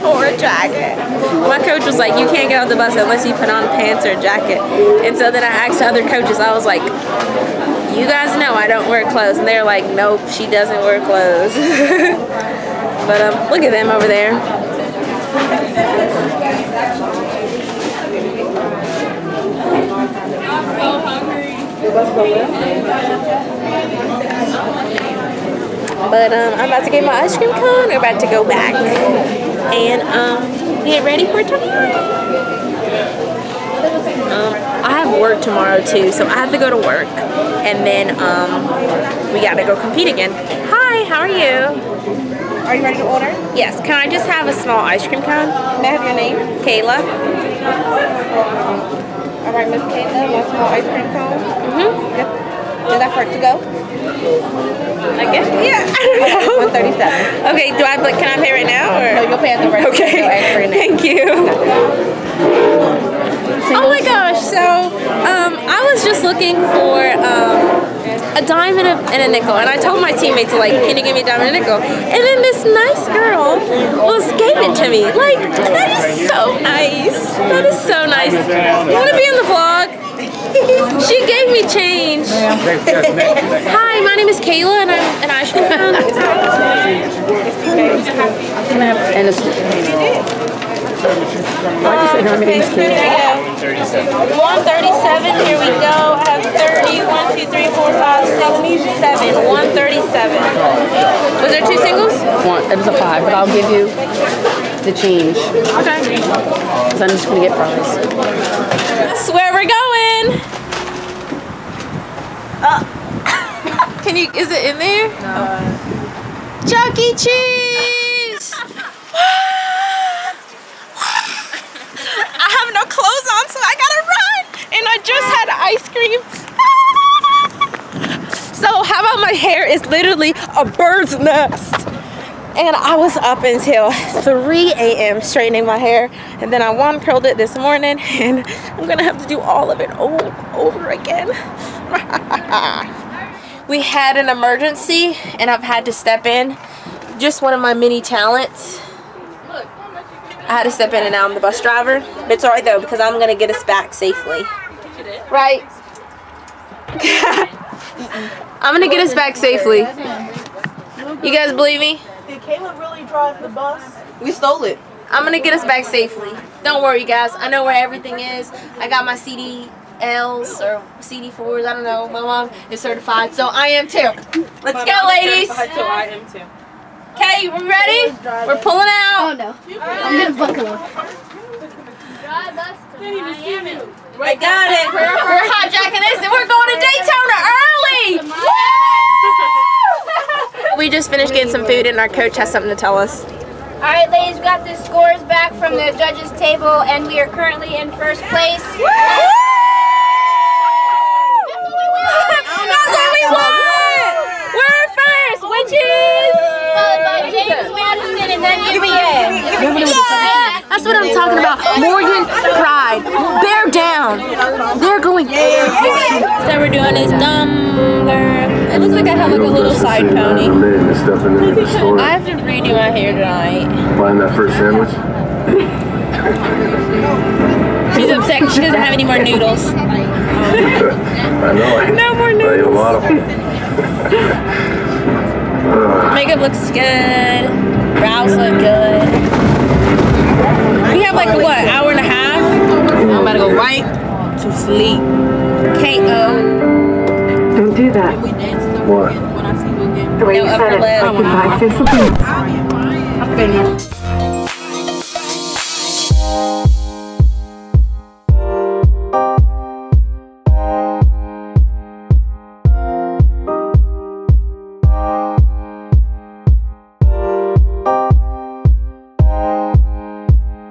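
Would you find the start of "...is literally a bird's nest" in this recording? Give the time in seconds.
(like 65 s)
129 s.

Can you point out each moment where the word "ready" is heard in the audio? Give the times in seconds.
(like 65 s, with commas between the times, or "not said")
31 s, 42 s, 177 s.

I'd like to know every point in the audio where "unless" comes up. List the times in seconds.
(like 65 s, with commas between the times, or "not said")
2 s.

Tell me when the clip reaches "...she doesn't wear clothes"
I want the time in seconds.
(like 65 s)
10 s.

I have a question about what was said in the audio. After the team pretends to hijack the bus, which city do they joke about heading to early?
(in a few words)
Daytona.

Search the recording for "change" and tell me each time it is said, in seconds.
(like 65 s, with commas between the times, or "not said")
81 s, 104 s.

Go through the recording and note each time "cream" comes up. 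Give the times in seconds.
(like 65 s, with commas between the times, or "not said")
27 s, 45 s, 50 s, 125 s.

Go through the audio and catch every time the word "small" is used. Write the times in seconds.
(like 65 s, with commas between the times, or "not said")
44 s, 50 s.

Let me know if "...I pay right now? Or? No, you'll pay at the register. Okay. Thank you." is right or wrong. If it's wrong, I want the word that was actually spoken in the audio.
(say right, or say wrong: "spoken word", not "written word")
right.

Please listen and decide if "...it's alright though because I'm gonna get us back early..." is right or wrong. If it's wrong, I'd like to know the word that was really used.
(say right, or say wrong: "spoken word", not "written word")
wrong: "safely", not "early".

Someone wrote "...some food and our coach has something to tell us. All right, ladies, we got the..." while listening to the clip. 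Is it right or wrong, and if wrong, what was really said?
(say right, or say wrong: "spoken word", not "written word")
right.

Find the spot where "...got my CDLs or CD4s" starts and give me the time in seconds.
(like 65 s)
168 s.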